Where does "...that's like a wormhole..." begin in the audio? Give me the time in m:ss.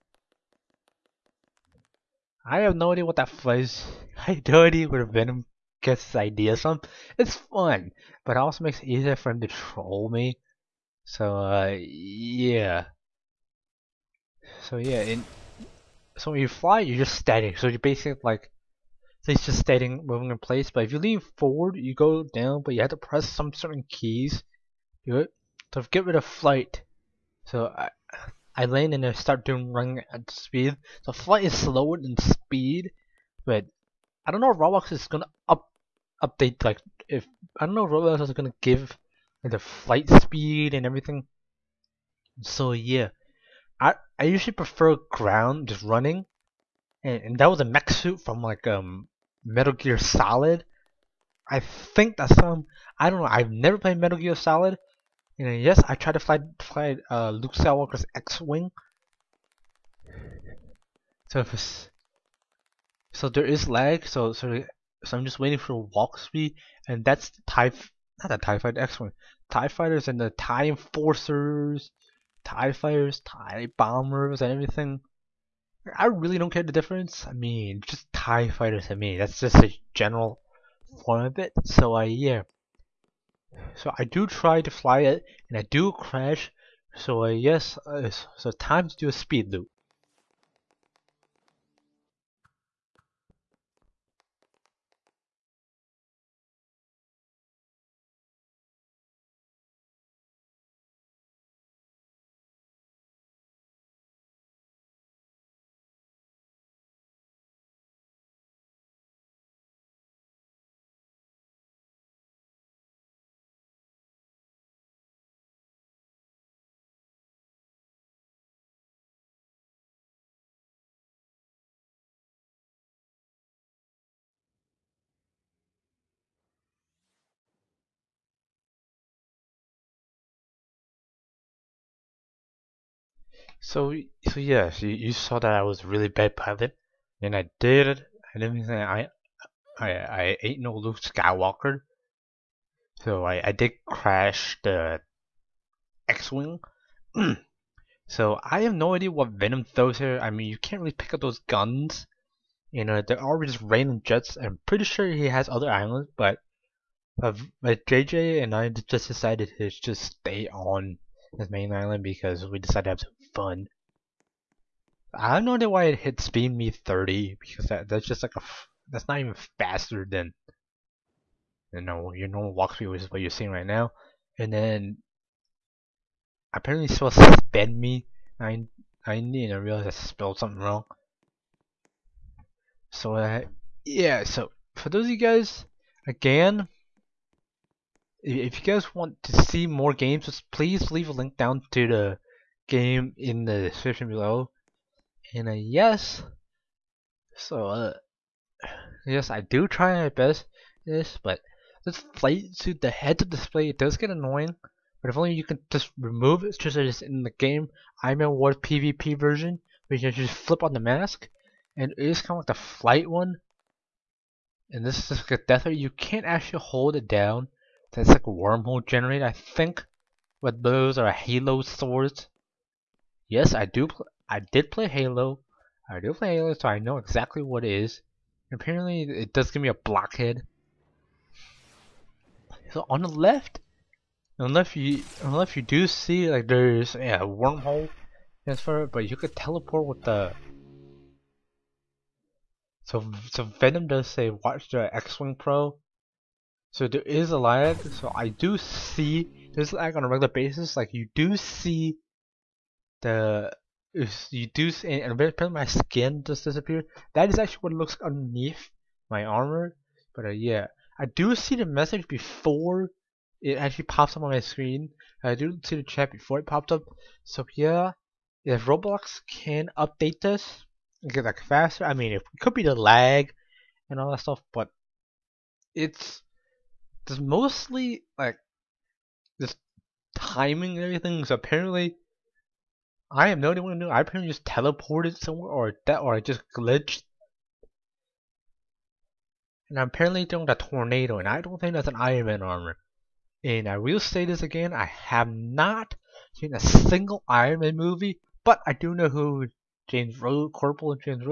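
3:37.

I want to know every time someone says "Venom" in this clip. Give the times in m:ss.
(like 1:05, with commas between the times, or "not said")
0:05, 2:29, 4:03.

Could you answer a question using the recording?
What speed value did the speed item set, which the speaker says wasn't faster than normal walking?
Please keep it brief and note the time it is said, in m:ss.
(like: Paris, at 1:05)
30, at 2:46.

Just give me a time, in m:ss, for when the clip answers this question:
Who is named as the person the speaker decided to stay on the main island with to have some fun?
2:37.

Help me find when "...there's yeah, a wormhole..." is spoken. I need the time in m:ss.
3:56.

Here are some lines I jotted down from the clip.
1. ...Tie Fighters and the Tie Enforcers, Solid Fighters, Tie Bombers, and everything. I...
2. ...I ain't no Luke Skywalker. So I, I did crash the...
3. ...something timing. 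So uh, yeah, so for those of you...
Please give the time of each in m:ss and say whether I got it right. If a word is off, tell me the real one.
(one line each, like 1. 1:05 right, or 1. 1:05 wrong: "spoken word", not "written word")
1. 1:09 wrong: "Tie", not "Solid"
2. 2:19 right
3. 3:00 wrong: "wrong", not "timing".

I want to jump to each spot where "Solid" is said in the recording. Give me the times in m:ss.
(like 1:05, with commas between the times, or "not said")
0:49, 0:54.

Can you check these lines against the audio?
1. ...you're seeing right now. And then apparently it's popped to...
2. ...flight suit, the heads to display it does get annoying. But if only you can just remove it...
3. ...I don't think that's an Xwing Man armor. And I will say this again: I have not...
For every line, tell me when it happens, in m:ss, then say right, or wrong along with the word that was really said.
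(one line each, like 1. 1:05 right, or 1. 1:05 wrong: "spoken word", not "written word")
1. 2:53 wrong: "supposed", not "popped"
2. 3:22 right
3. 4:51 wrong: "Iron", not "Xwing".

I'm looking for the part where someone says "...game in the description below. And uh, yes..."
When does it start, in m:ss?
3:12.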